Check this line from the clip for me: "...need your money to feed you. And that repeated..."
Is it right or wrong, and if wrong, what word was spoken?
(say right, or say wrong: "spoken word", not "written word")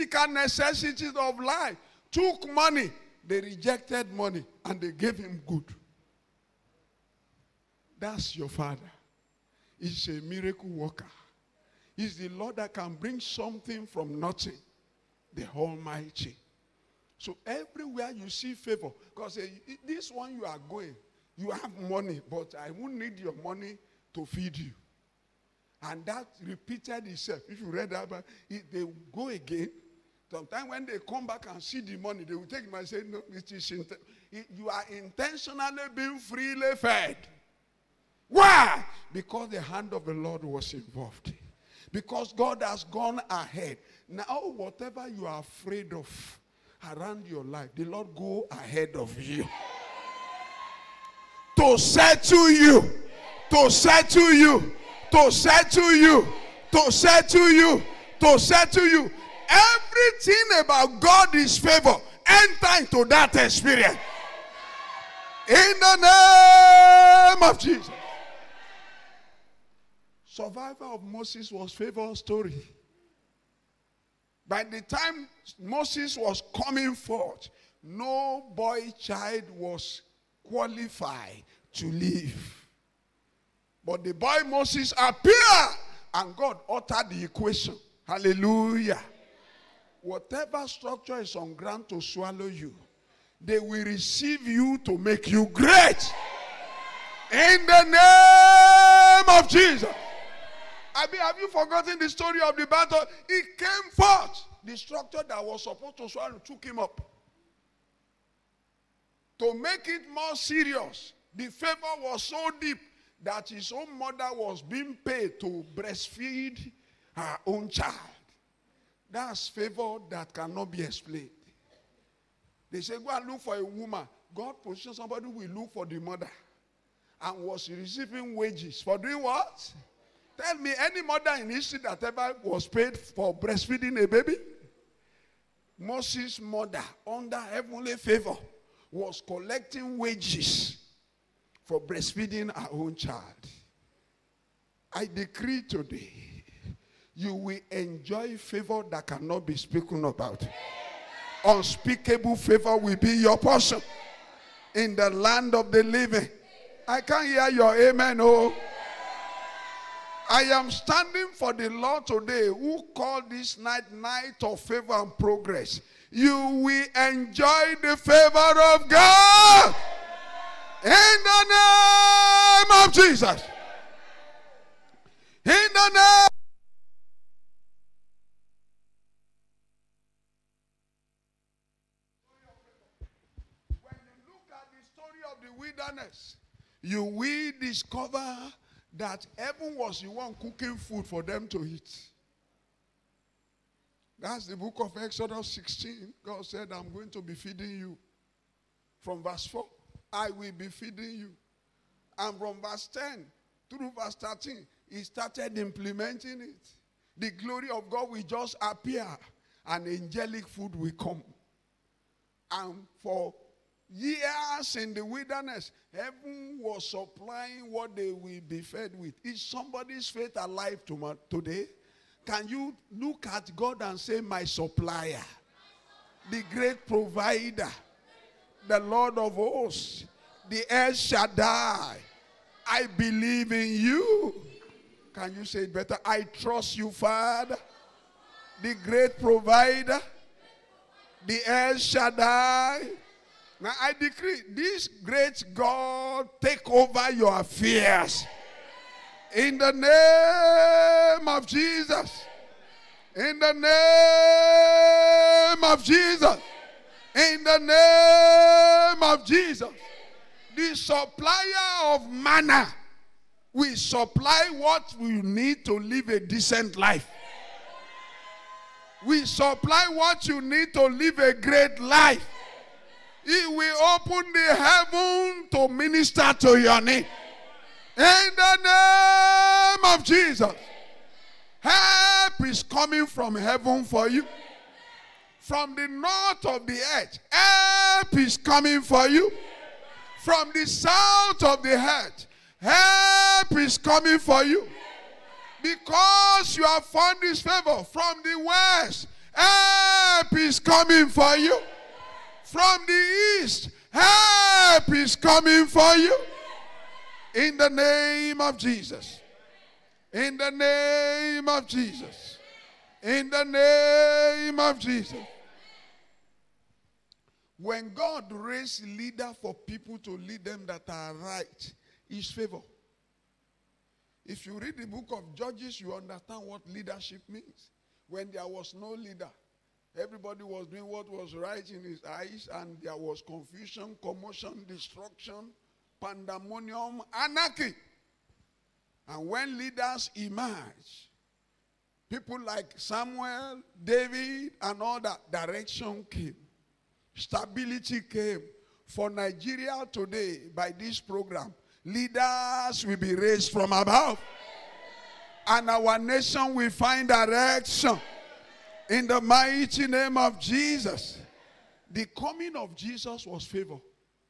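right.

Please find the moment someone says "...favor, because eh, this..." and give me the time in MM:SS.
00:18.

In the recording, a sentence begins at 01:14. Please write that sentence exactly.
By the time Moses was coming forth, no boy child was qualified to live.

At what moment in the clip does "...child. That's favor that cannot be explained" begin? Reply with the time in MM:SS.
01:57.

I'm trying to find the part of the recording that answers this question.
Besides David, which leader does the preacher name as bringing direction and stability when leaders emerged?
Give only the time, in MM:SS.
05:42.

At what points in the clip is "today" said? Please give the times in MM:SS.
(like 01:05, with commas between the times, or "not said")
02:25, 02:42, 03:41, 05:49.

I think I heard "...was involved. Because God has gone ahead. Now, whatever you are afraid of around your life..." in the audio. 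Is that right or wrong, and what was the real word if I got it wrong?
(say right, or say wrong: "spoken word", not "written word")
right.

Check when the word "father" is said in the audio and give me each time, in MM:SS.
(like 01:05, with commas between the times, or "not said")
00:08, 03:56.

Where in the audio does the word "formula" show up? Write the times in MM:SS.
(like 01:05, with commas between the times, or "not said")
not said.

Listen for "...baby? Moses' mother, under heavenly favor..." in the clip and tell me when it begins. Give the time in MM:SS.
02:14.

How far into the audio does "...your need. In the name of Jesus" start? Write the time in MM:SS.
04:36.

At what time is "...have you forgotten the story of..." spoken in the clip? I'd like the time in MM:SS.
01:41.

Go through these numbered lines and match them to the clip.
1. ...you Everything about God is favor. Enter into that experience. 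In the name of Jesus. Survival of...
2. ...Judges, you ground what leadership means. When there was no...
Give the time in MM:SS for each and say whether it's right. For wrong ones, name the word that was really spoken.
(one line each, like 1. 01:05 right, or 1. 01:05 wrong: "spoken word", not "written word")
1. 00:58 right
2. 05:25 wrong: "understand", not "ground".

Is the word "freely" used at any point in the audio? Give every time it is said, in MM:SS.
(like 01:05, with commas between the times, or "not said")
00:36.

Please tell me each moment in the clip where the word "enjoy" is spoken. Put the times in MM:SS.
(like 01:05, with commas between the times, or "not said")
02:27, 02:47.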